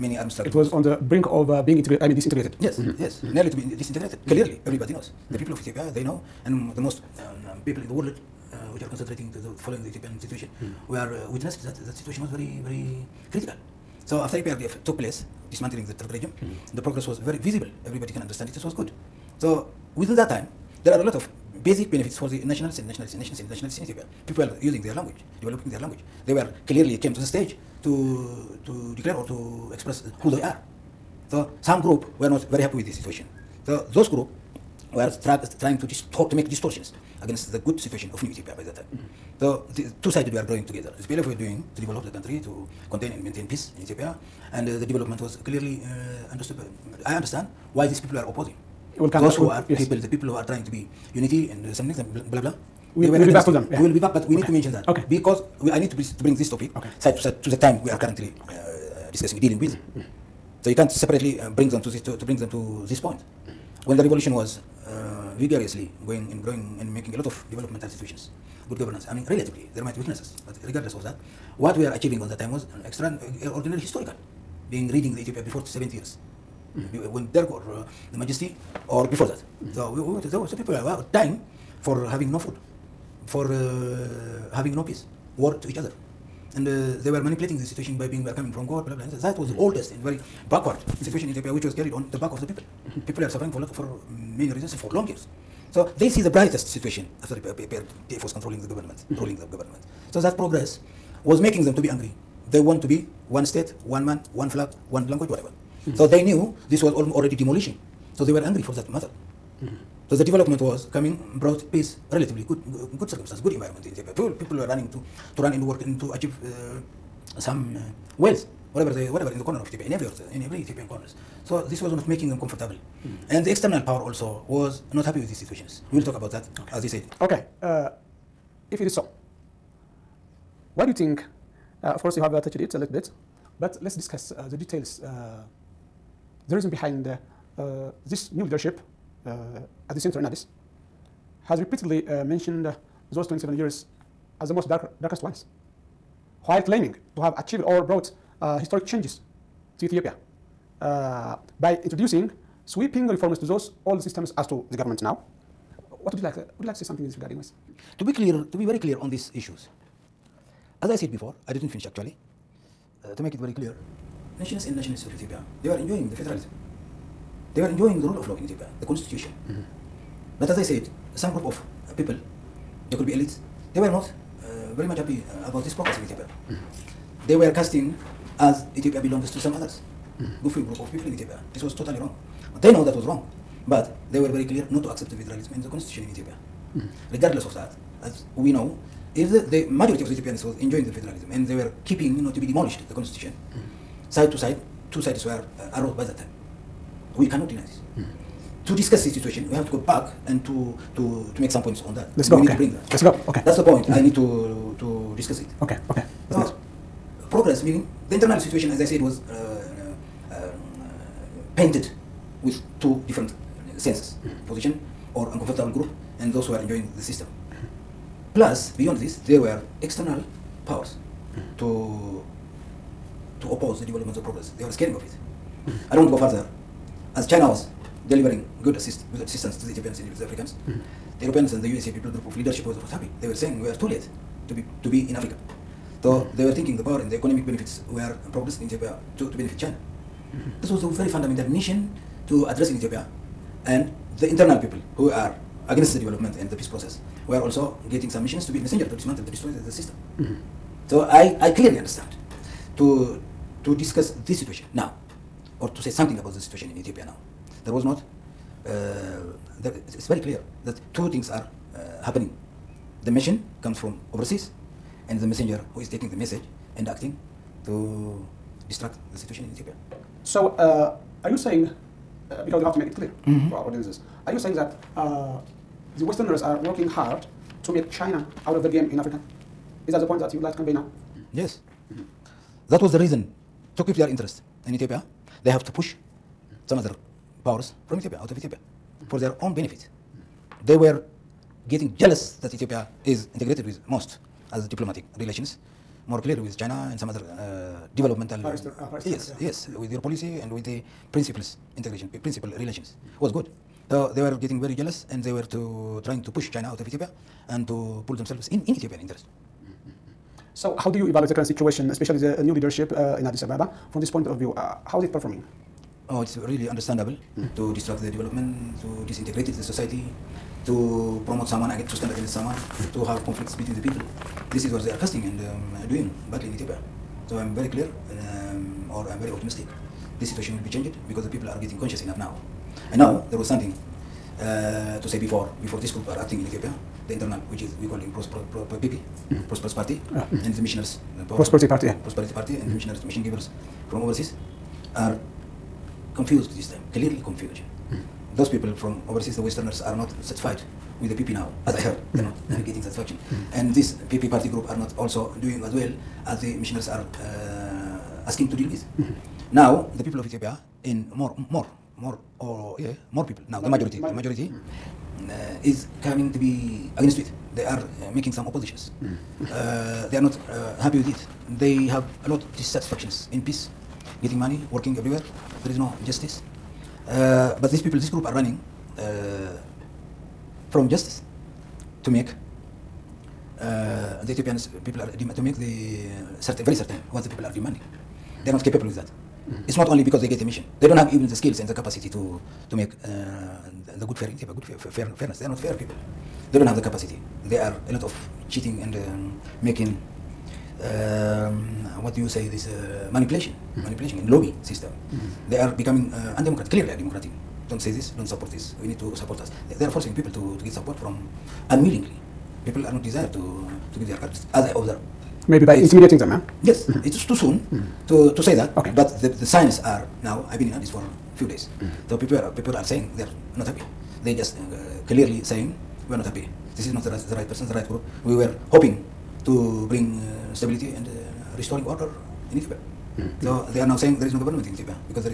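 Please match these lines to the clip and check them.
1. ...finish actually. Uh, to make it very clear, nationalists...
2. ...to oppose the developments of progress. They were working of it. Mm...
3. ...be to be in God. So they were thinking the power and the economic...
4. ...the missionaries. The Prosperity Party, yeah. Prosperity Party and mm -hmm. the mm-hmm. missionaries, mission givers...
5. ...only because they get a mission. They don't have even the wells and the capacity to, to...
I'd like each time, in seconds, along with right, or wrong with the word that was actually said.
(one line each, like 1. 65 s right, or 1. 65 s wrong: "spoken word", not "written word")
1. 161 s right
2. 223 s wrong: "scaring", not "working"
3. 234 s wrong: "Africa", not "God"
4. 340 s right
5. 389 s wrong: "skills", not "wells".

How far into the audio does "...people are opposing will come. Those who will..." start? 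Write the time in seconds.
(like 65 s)
47 s.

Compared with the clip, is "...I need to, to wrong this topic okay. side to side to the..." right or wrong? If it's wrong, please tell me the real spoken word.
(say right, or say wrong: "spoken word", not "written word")
wrong: "bring", not "wrong".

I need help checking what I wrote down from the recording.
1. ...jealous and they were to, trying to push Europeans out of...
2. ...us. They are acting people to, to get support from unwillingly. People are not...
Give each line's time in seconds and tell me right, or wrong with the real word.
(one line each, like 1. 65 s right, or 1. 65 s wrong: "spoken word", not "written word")
1. 304 s wrong: "China", not "Europeans"
2. 409 s wrong: "forcing", not "acting".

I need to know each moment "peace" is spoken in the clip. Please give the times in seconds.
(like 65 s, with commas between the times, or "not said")
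43 s, 84 s, 111 s, 246 s, 373 s.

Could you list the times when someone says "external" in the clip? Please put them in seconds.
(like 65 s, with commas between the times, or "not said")
123 s, 219 s.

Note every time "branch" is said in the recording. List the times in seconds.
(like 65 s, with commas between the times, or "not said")
not said.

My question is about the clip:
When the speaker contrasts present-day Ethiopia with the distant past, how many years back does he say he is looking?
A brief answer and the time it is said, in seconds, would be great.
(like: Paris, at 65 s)
70 years, at 75 s.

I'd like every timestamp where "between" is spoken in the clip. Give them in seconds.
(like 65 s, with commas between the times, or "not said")
323 s.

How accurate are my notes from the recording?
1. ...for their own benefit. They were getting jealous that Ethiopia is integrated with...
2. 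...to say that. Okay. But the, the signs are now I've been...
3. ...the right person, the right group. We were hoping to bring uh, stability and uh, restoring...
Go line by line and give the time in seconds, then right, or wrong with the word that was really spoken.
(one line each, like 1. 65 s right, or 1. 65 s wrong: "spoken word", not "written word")
1. 289 s right
2. 418 s right
3. 427 s right.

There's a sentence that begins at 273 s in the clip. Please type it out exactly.
for our audiences, are you saying that uh, the Westerners are working hard to make China out of the game in Africa?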